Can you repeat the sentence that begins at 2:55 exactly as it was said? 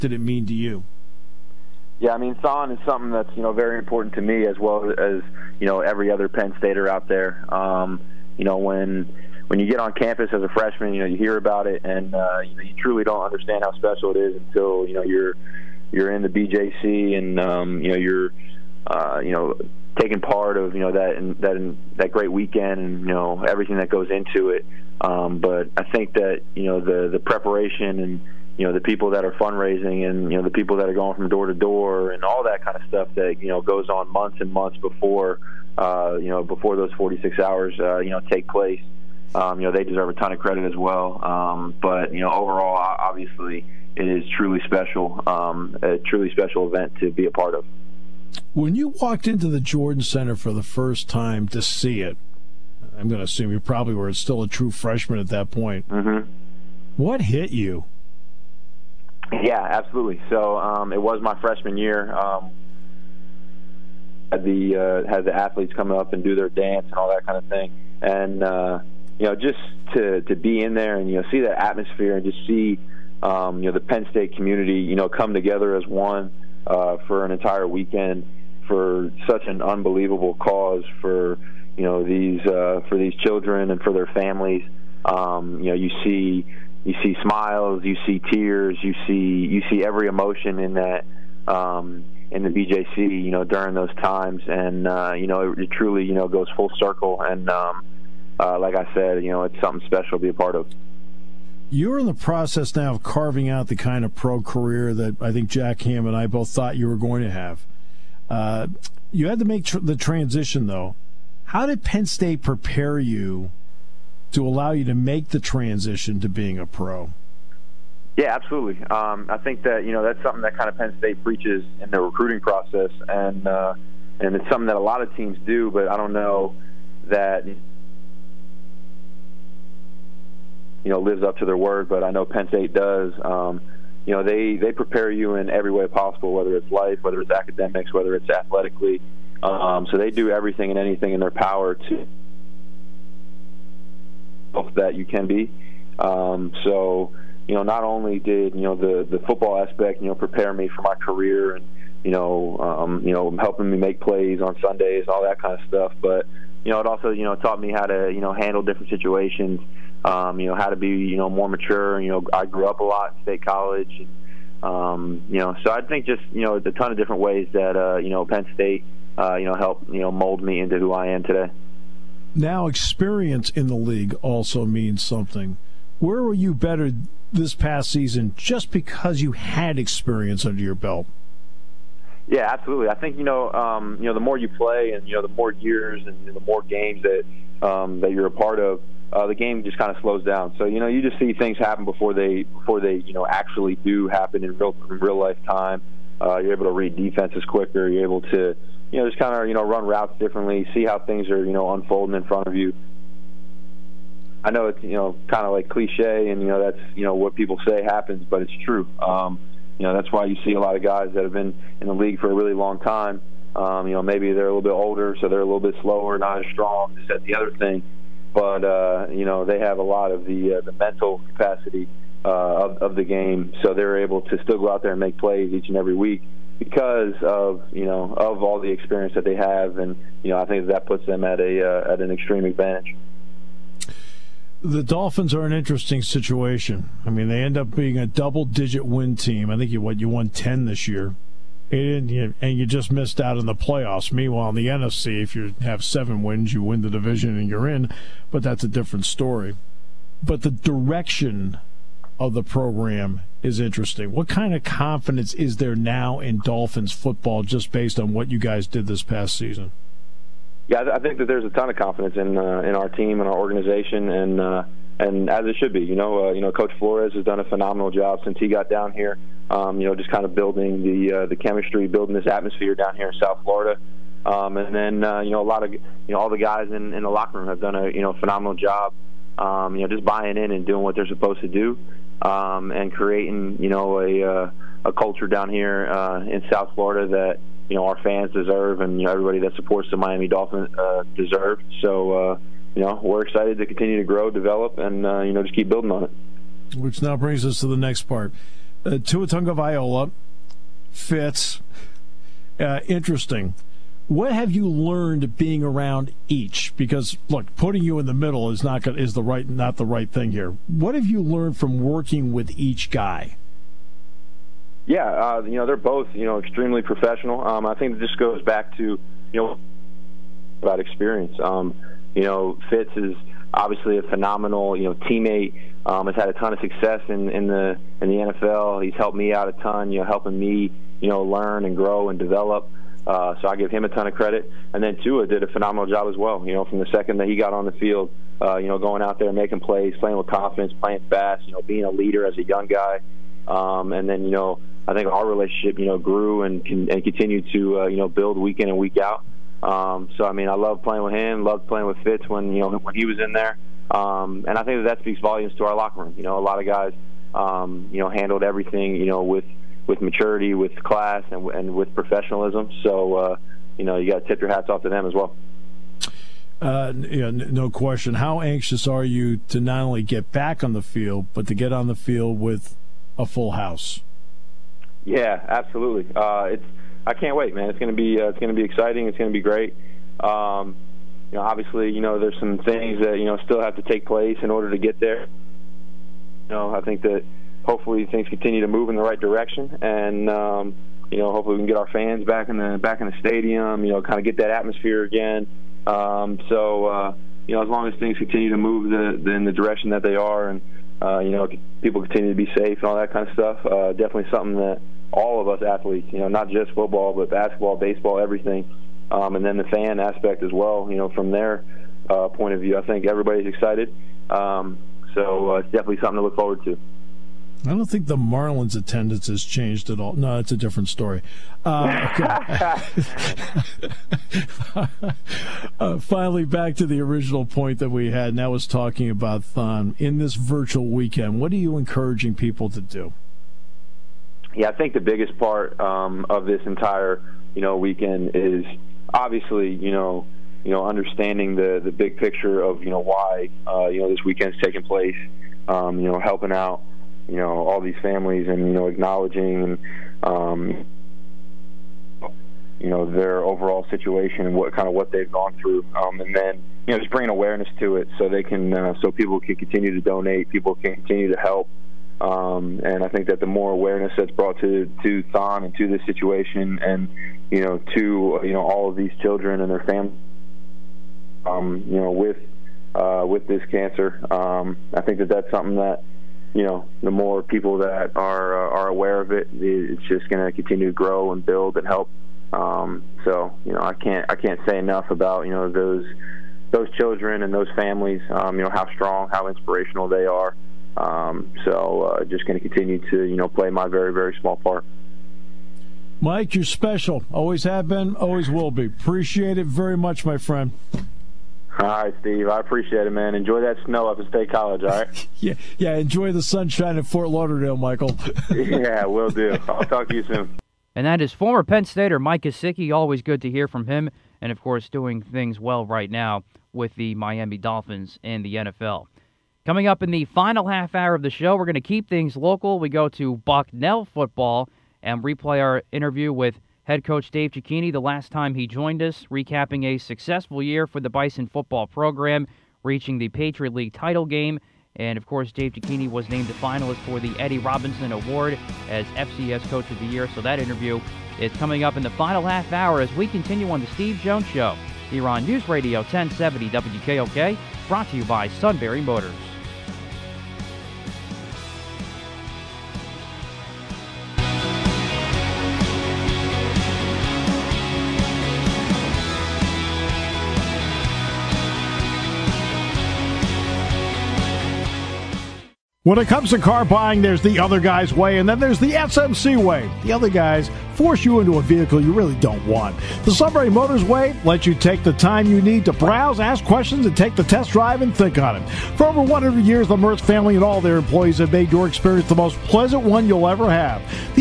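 Where were you better this past season just because you had experience under your belt?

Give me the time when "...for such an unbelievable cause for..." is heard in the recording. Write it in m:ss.
1:18.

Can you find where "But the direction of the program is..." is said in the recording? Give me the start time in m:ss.
4:10.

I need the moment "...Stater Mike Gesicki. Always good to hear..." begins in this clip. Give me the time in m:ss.
8:31.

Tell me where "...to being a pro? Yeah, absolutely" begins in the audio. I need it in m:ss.
1:56.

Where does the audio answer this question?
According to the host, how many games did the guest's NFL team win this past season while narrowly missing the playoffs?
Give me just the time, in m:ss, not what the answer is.
4:00.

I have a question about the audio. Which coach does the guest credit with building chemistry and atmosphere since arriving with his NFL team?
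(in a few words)
Coach Flores.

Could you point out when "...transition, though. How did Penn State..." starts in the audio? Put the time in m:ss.
1:49.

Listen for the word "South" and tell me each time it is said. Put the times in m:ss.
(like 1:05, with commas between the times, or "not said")
4:33, 4:46.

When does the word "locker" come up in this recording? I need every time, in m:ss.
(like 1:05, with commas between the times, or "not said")
4:37, 5:55.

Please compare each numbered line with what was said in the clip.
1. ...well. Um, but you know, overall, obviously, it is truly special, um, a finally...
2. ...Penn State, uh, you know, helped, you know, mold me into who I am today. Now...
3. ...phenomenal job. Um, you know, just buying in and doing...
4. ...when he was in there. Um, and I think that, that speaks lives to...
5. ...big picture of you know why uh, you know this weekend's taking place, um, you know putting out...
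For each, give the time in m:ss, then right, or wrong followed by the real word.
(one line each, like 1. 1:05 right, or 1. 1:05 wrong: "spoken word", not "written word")
1. 0:40 wrong: "truly", not "finally"
2. 2:48 right
3. 4:38 right
4. 5:52 wrong: "volumes", not "lives"
5. 7:21 wrong: "helping", not "putting".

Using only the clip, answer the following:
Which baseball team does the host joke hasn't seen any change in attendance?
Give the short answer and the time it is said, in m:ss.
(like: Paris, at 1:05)
Marlins, at 6:58.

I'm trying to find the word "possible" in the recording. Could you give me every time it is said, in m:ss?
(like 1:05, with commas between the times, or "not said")
2:15.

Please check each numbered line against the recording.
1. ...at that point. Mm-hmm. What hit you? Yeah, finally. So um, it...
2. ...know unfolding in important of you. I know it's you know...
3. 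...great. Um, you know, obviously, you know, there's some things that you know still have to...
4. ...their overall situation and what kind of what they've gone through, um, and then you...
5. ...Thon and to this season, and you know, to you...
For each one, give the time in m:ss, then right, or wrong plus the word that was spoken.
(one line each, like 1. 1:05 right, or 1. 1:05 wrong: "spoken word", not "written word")
1. 0:55 wrong: "absolutely", not "finally"
2. 3:21 wrong: "front", not "important"
3. 6:19 right
4. 7:33 right
5. 7:45 wrong: "situation", not "season".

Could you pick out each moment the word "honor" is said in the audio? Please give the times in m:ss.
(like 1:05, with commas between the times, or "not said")
not said.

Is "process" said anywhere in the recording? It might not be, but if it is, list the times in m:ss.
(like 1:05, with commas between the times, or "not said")
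1:42, 2:02.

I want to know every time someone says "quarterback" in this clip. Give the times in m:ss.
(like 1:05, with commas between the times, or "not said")
not said.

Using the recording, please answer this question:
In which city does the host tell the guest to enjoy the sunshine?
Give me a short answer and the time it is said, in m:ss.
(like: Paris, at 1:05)
Fort Lauderdale, at 8:27.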